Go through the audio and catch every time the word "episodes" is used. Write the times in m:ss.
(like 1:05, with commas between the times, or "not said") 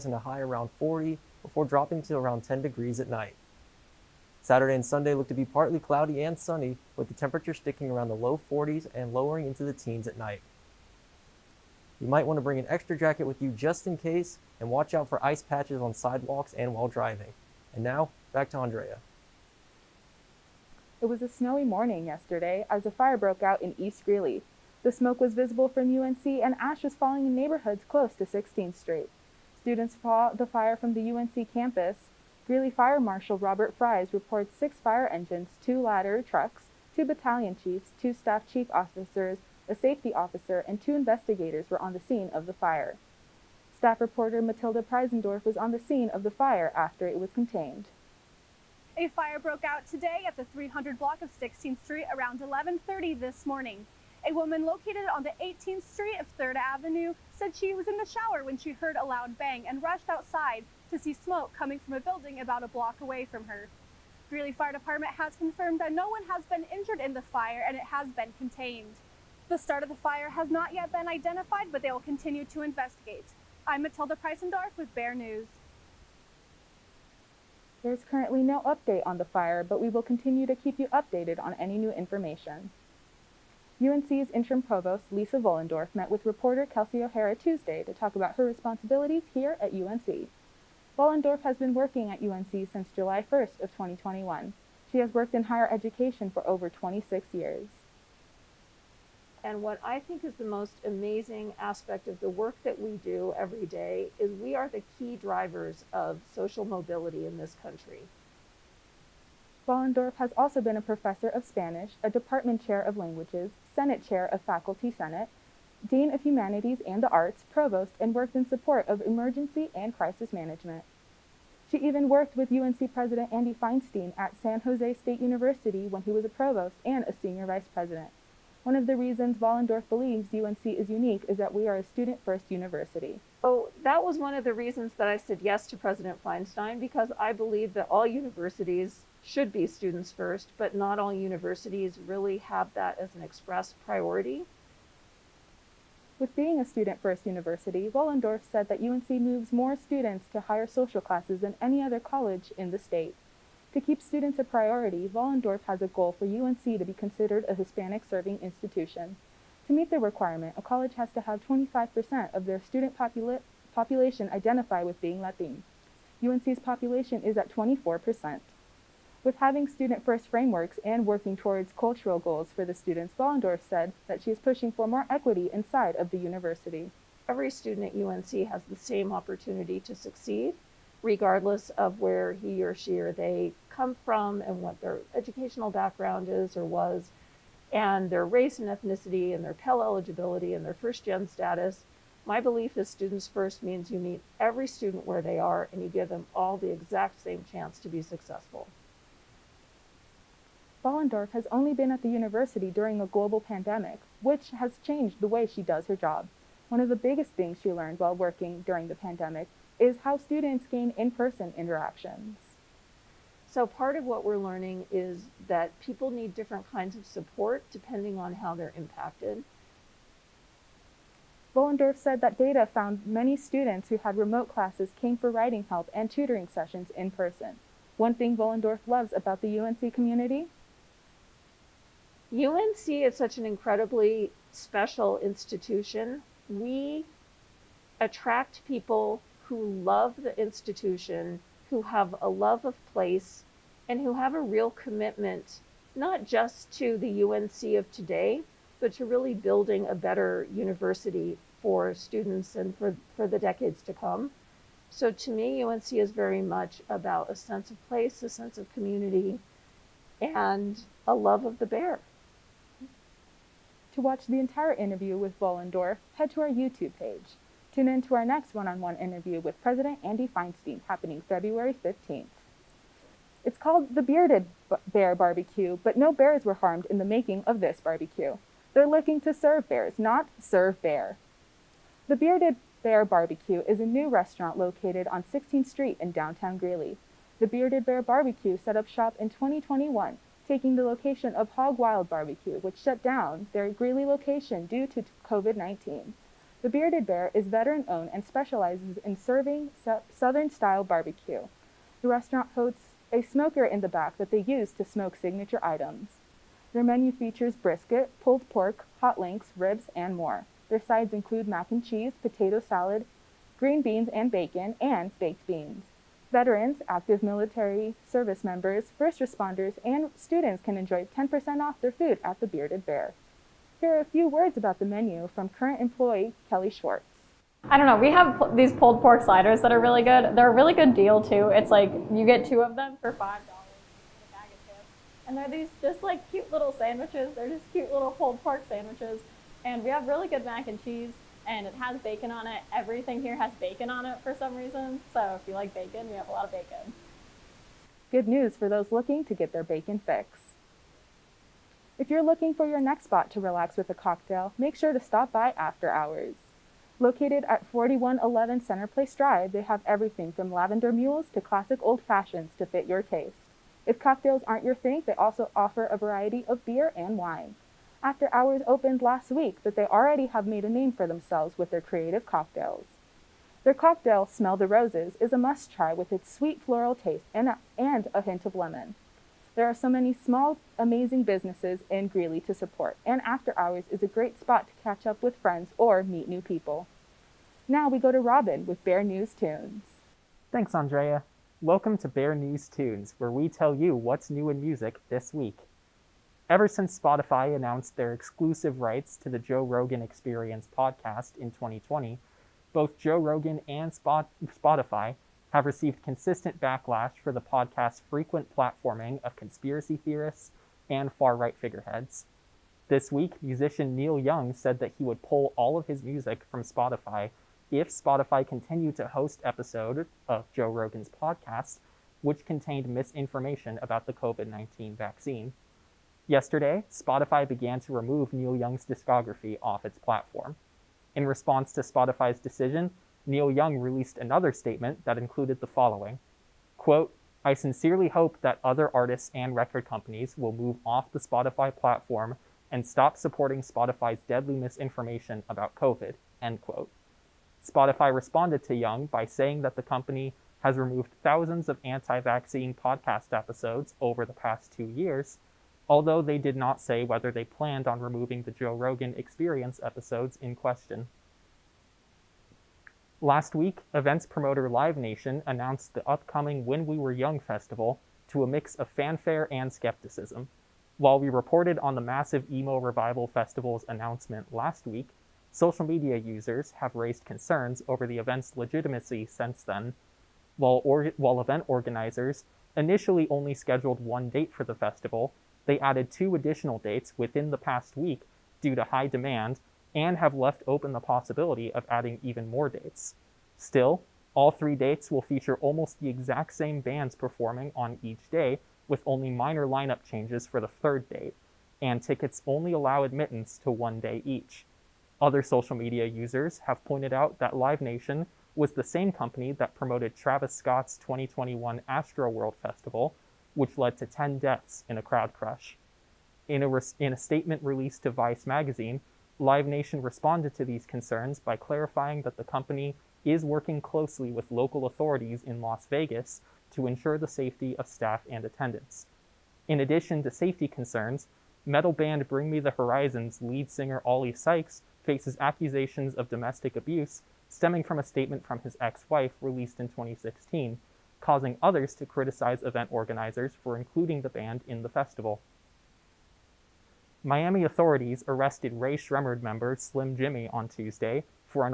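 6:59, 7:33, 7:39.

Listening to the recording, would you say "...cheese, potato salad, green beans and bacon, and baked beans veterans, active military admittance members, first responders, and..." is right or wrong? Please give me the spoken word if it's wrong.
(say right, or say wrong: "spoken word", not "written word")
wrong: "service", not "admittance".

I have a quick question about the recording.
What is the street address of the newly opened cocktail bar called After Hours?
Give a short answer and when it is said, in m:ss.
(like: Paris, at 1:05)
4111 Center Place Drive, at 5:57.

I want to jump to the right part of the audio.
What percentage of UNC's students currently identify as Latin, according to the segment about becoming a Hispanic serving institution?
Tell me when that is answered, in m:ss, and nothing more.
2:47.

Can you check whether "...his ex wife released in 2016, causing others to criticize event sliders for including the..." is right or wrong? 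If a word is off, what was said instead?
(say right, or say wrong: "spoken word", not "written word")
wrong: "organizers", not "sliders".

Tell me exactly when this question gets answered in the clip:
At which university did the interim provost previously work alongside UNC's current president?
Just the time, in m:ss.
2:04.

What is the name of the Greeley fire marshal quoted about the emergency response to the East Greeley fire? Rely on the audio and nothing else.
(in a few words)
Robert Fries.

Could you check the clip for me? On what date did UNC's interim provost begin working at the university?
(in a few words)
July 1, 2021.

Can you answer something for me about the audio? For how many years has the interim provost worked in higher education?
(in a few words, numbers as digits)
26.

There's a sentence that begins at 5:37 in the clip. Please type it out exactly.
They're just cute little pulled pork sandwiches, and we have really good mac and cheese and it has bacon on it.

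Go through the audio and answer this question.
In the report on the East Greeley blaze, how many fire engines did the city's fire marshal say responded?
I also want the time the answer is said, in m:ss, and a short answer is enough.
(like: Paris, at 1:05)
6, at 0:34.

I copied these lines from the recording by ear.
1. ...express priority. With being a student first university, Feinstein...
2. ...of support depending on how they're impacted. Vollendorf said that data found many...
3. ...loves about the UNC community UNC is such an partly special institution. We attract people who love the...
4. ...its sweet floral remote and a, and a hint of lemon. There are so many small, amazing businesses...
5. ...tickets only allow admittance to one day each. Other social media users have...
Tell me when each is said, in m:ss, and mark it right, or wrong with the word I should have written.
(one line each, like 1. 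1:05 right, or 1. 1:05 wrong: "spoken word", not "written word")
1. 2:23 wrong: "Vollendorf", not "Feinstein"
2. 3:36 right
3. 3:48 wrong: "incredibly", not "partly"
4. 6:16 wrong: "taste", not "remote"
5. 8:22 right.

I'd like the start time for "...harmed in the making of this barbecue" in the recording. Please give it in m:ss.
4:36.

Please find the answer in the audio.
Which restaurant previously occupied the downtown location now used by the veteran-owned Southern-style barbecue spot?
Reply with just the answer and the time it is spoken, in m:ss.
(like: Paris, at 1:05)
Hog Wild Barbecue, at 4:51.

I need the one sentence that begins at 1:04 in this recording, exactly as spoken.
Greeley Fire Department has confirmed that no one has been injured in the fire and it has been contained.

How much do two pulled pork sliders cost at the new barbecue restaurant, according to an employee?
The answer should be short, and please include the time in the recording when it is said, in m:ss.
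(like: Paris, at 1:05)
$5, at 5:33.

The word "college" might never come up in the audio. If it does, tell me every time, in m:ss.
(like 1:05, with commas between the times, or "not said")
2:31, 2:40.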